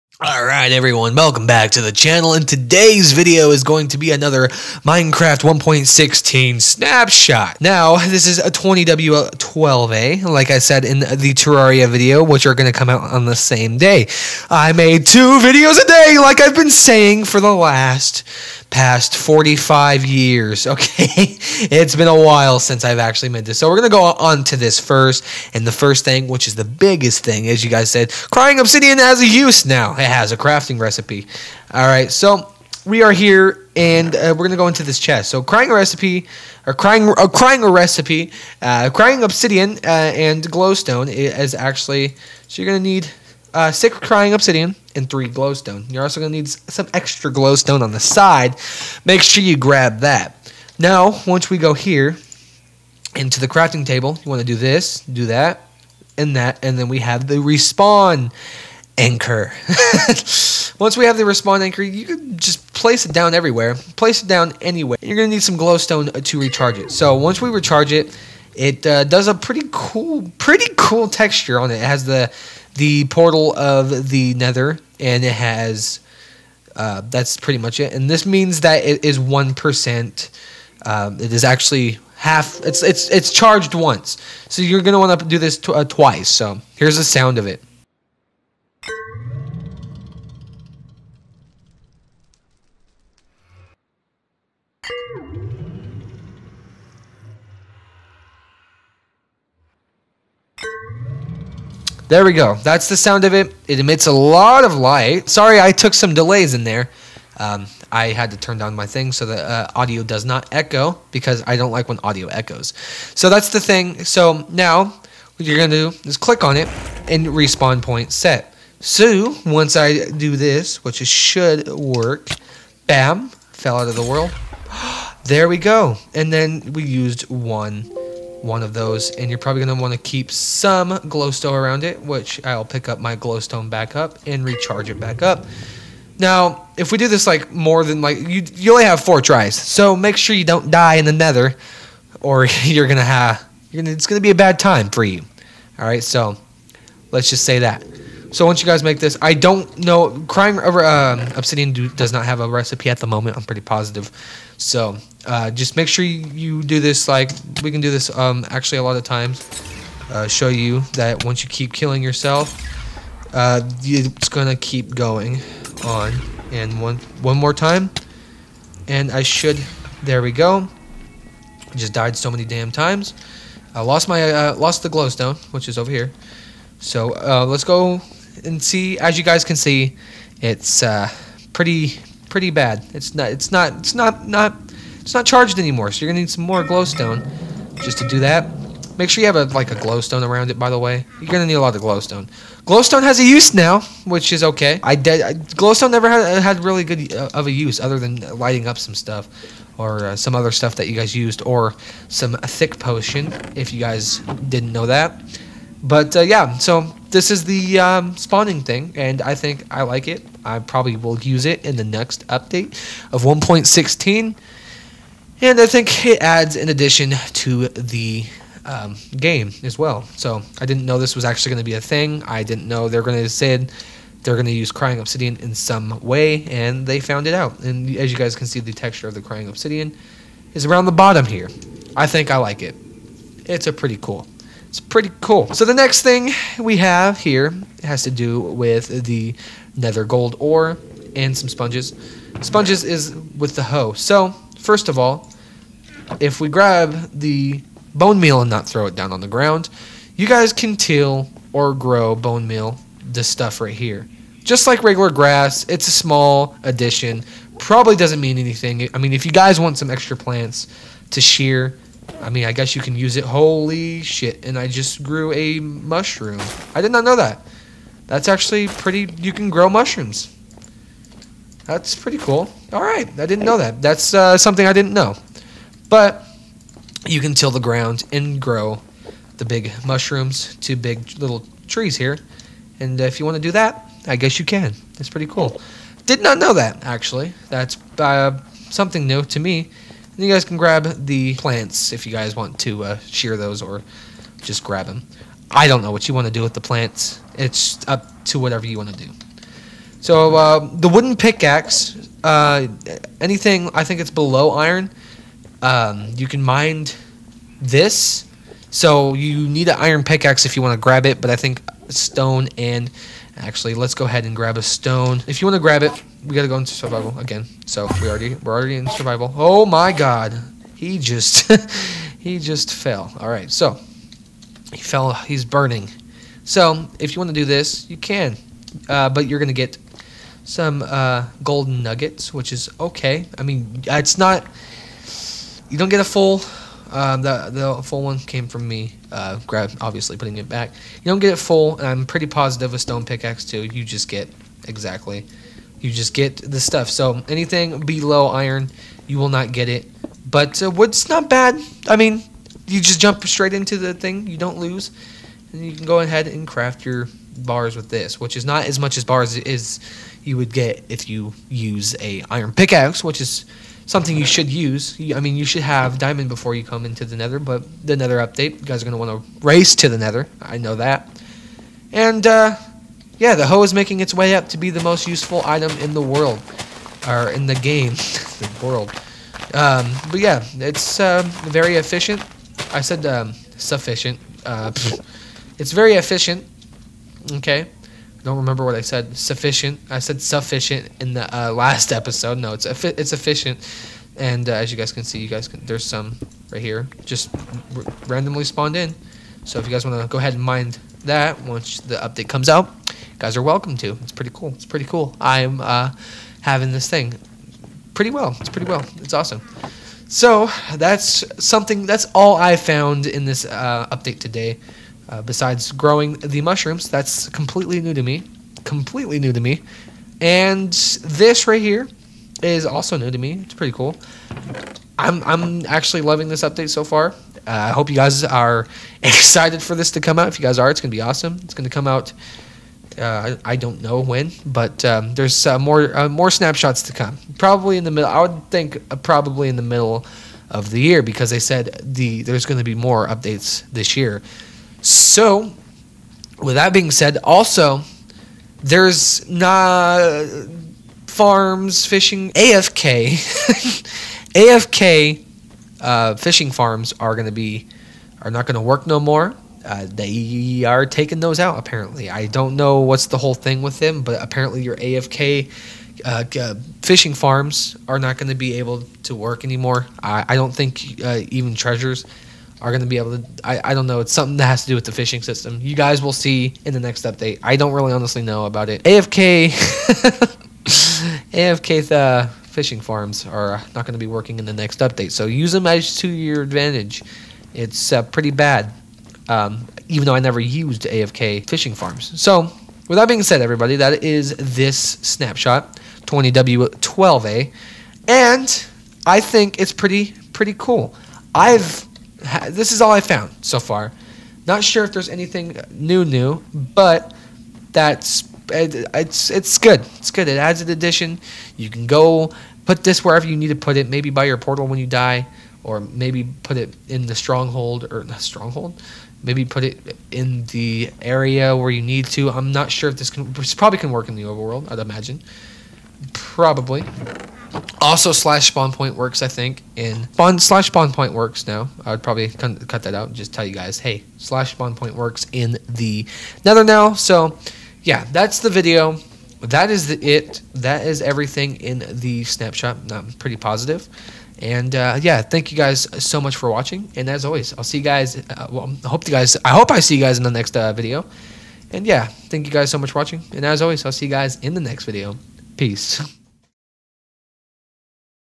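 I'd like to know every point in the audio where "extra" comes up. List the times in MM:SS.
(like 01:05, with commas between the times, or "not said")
00:46, 04:19.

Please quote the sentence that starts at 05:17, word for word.
So we already we're already in survival.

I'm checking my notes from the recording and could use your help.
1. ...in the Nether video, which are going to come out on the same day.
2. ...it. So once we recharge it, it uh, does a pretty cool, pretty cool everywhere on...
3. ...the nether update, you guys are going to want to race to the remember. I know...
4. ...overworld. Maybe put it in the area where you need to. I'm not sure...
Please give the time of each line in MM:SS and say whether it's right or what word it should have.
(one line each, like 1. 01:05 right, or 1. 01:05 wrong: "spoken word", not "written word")
1. 00:10 wrong: "Terraria", not "Nether"
2. 01:06 wrong: "texture", not "everywhere"
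3. 06:07 wrong: "nether", not "remember"
4. 08:38 wrong: "stronghold", not "overworld".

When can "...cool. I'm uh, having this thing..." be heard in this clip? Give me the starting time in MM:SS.
06:44.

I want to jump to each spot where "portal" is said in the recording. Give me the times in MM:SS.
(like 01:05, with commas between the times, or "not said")
01:13, 08:34.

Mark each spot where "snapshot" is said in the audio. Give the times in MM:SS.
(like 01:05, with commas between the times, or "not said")
00:06, 07:16, 08:14, 09:02.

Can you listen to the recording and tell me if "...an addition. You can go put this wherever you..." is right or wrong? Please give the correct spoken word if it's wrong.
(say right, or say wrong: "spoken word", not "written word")
right.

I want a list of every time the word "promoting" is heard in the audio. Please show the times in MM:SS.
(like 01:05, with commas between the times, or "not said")
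not said.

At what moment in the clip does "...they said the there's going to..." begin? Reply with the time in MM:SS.
07:21.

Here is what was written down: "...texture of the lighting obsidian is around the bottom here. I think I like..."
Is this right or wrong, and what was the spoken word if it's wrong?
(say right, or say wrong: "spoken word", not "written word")
wrong: "crying", not "lighting".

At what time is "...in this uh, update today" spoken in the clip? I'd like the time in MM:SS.
06:53.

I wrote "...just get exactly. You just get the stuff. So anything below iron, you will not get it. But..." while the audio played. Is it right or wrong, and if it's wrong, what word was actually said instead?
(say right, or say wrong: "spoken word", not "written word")
right.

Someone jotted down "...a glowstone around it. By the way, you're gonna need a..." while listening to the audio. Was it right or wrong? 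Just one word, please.
right.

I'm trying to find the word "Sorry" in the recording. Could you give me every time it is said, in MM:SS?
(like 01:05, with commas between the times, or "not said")
01:45.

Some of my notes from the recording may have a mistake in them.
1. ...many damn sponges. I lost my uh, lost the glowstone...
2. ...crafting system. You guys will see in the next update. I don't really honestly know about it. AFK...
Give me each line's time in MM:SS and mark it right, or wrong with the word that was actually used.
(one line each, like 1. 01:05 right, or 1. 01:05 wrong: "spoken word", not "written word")
1. 02:52 wrong: "times", not "sponges"
2. 07:54 wrong: "fishing", not "crafting".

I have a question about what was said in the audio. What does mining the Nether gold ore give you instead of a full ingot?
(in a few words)
golden nuggets.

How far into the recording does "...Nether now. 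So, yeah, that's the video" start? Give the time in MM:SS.
08:56.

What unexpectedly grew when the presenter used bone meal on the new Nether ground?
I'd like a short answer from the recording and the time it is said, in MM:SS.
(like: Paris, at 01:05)
a mushroom, at 04:25.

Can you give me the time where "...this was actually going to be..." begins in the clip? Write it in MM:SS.
03:40.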